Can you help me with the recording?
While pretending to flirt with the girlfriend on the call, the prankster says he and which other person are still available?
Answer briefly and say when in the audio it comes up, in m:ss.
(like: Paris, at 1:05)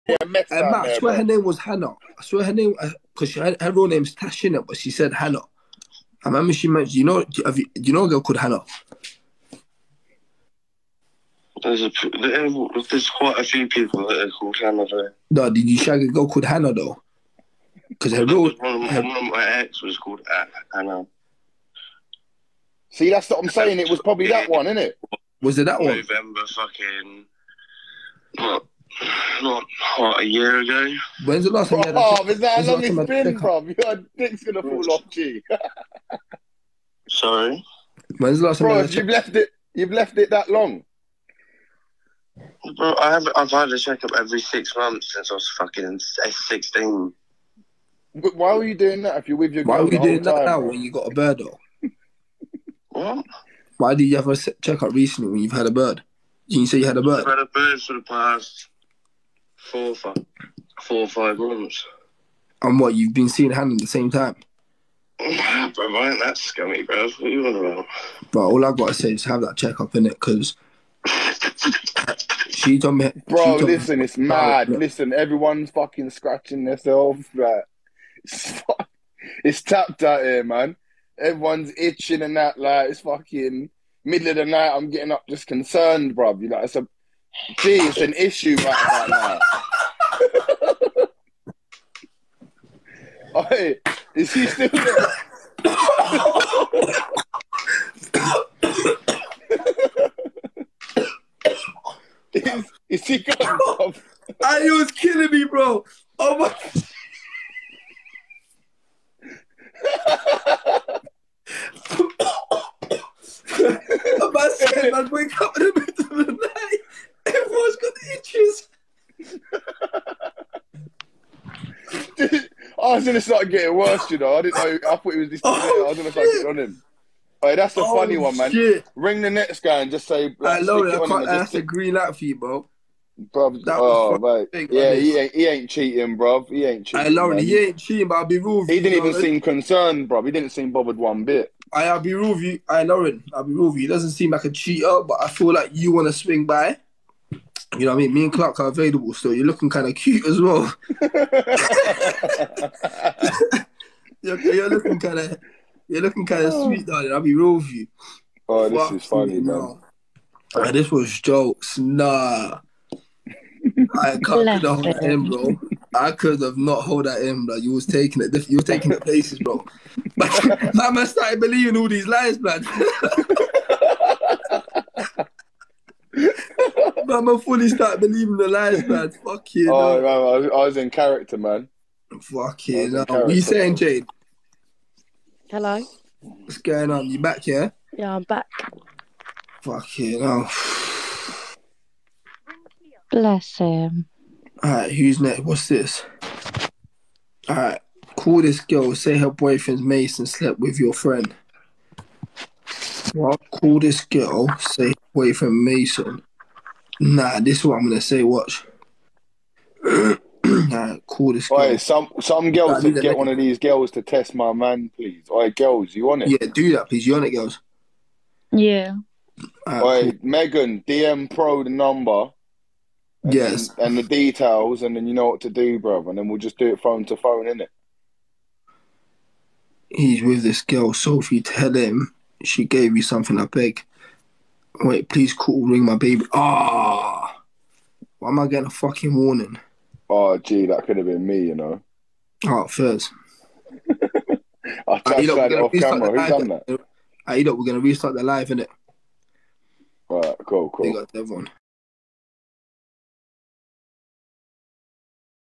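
Clark, at 2:28.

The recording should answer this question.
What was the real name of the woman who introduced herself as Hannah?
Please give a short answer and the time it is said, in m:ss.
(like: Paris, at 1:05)
Tash, at 0:04.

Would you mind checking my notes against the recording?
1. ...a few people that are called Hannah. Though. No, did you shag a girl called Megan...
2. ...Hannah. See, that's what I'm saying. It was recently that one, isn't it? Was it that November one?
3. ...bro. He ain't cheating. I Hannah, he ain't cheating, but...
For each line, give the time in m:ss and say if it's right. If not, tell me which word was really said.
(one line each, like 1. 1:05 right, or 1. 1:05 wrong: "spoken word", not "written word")
1. 0:13 wrong: "Hannah", not "Megan"
2. 0:20 wrong: "probably", not "recently"
3. 2:16 wrong: "Lauren", not "Hannah".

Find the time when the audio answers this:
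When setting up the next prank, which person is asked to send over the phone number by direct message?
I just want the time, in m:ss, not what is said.
3:40.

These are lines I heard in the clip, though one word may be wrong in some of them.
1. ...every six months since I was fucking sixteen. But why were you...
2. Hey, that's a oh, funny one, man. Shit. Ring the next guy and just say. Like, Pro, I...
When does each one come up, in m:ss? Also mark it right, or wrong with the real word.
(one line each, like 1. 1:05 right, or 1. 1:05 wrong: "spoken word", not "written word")
1. 0:44 right
2. 2:07 wrong: "Lauren", not "Pro".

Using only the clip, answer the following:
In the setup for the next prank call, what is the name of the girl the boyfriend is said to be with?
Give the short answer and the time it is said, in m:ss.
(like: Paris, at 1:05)
Sophie, at 3:50.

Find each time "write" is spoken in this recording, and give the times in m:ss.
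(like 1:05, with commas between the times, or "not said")
not said.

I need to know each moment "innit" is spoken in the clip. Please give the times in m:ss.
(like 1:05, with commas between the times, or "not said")
3:47, 4:08.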